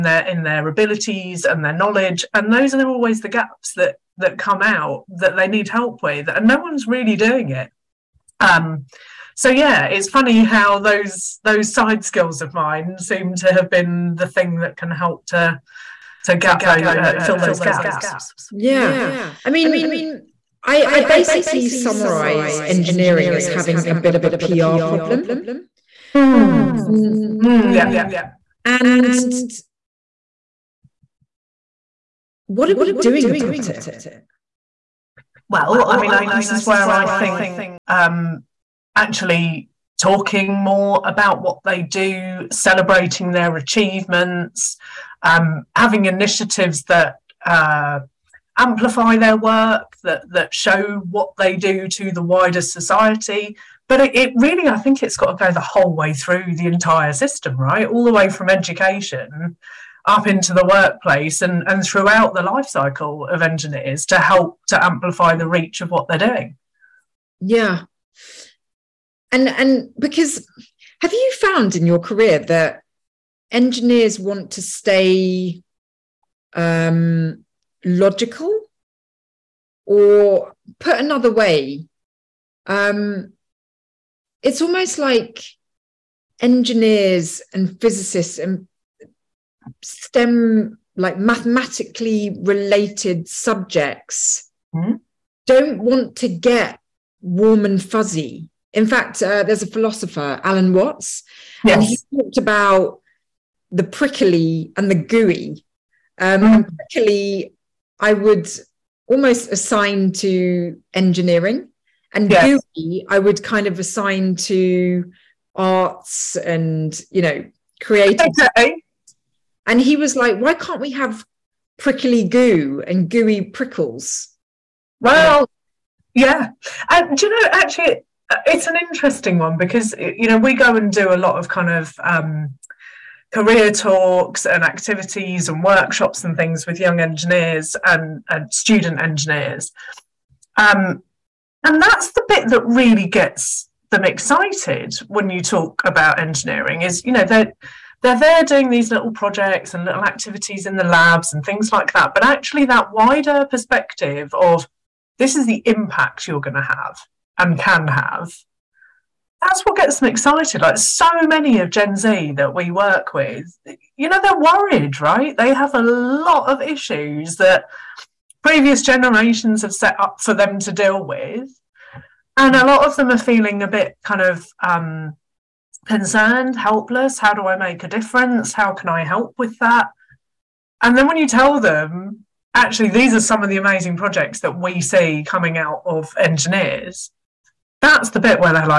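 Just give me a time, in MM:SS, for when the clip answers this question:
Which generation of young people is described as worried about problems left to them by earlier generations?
02:41.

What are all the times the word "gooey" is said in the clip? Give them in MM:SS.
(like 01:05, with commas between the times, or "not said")
01:44, 02:03.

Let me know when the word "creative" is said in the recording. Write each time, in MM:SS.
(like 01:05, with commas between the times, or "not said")
01:57.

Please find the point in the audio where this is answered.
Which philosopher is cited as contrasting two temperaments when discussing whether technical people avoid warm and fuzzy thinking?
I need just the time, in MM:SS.
01:40.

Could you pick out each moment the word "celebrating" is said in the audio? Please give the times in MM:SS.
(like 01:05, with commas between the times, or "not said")
00:42.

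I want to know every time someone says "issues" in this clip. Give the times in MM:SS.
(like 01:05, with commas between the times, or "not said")
02:46.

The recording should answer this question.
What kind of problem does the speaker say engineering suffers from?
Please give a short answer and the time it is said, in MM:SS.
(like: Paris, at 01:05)
PR problem, at 00:24.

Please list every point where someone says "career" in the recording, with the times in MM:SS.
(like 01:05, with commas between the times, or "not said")
01:11, 02:13.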